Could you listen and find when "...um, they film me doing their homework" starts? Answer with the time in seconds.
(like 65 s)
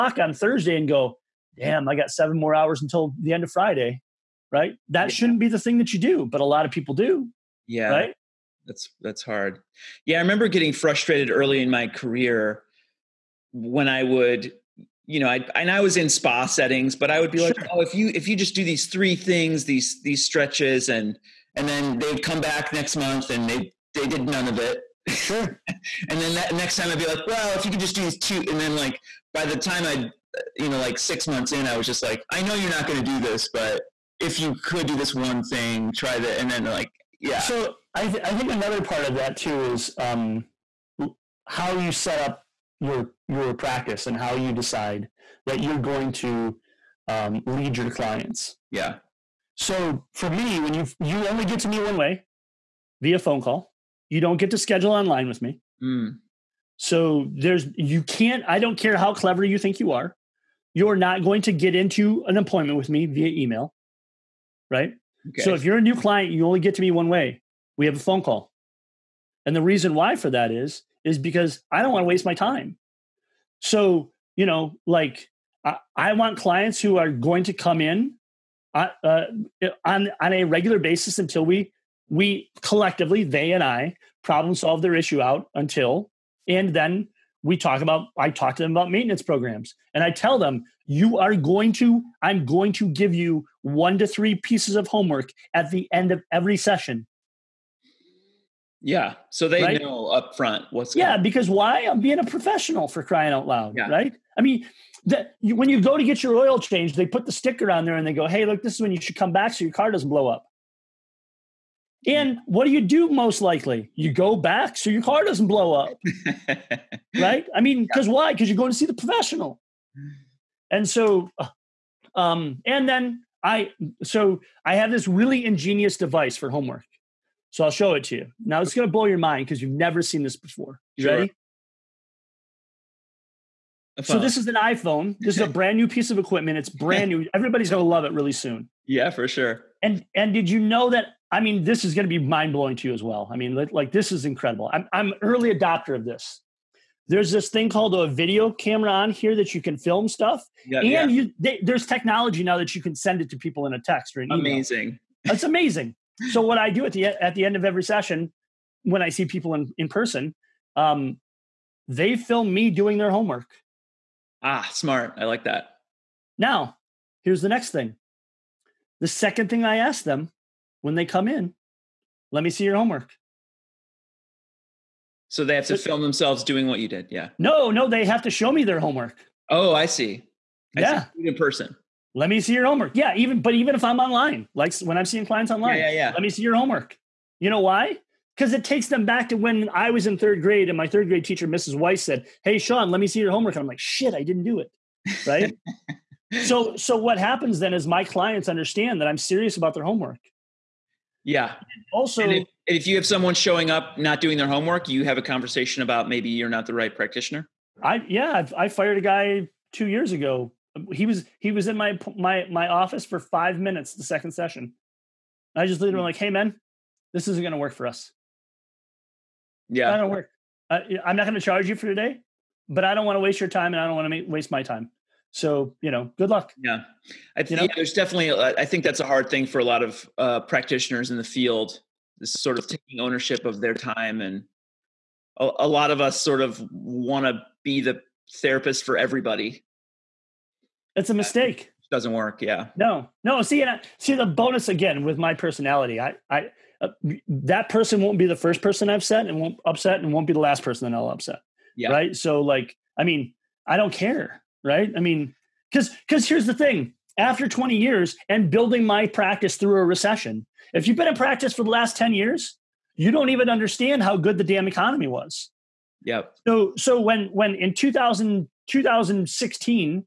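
160 s.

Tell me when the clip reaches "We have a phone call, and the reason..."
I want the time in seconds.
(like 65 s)
67 s.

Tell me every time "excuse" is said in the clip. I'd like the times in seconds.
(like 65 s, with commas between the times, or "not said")
not said.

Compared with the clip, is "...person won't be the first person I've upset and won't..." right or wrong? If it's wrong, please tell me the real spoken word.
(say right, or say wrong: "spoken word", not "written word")
right.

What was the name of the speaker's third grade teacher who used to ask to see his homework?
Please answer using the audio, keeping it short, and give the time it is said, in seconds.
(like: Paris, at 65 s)
Mrs. Weiss, at 191 s.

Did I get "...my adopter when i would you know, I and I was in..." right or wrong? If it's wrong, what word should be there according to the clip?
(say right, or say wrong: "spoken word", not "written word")
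wrong: "career", not "adopter".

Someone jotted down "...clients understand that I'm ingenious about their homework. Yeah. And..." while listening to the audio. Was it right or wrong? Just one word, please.
wrong.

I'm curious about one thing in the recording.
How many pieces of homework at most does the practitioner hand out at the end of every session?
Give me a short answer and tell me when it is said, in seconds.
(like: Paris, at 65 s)
3, at 93 s.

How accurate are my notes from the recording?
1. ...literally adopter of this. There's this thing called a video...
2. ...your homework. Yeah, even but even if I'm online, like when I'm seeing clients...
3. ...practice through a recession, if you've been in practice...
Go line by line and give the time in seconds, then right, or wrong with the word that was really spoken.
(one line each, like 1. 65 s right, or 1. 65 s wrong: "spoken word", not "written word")
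1. 145 s wrong: "early", not "literally"
2. 182 s right
3. 259 s right.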